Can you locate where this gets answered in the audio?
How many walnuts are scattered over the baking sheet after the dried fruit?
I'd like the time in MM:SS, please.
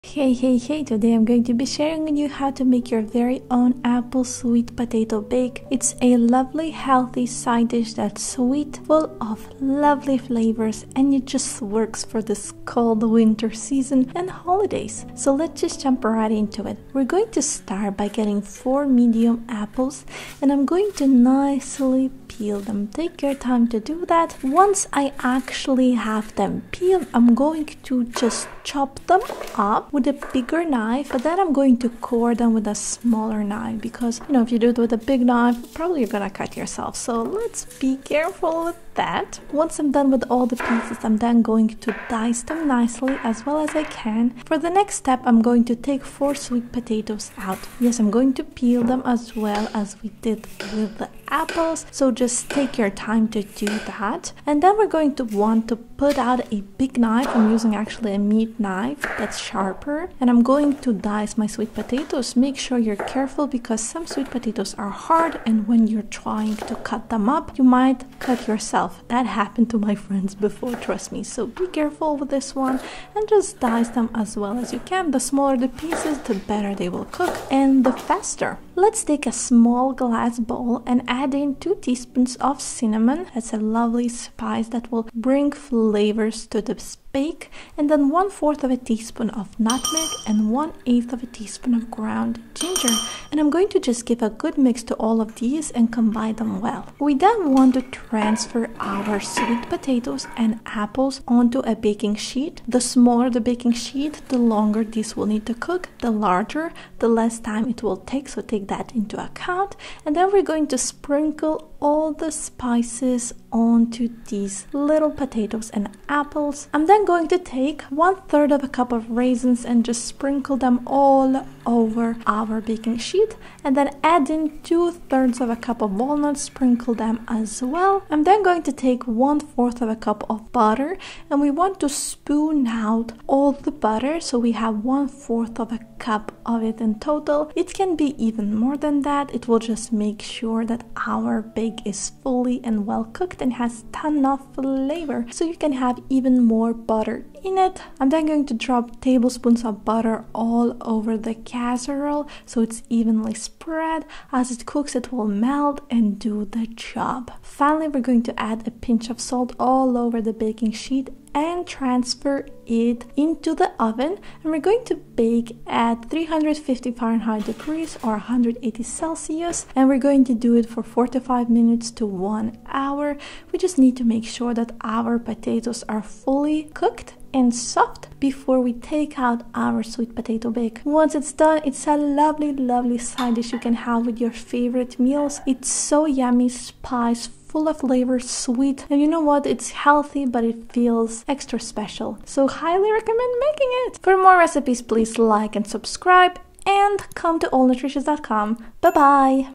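02:04.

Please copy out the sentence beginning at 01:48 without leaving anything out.
So take that into account and then we're going to sprinkle all the spices onto these little potatoes and apples.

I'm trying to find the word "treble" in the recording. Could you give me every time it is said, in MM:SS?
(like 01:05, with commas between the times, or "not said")
not said.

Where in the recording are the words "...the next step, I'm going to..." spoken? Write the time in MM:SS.
00:44.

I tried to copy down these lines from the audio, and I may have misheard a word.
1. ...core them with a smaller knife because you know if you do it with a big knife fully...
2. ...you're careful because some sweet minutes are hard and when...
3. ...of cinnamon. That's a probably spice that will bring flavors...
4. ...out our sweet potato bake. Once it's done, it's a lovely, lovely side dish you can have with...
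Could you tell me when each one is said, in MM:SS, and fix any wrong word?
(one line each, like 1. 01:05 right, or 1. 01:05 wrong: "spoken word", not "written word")
1. 00:31 wrong: "probably", not "fully"
2. 01:02 wrong: "potatoes", not "minutes"
3. 01:22 wrong: "lovely", not "probably"
4. 02:59 right.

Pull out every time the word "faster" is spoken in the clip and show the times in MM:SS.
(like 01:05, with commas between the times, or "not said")
01:17.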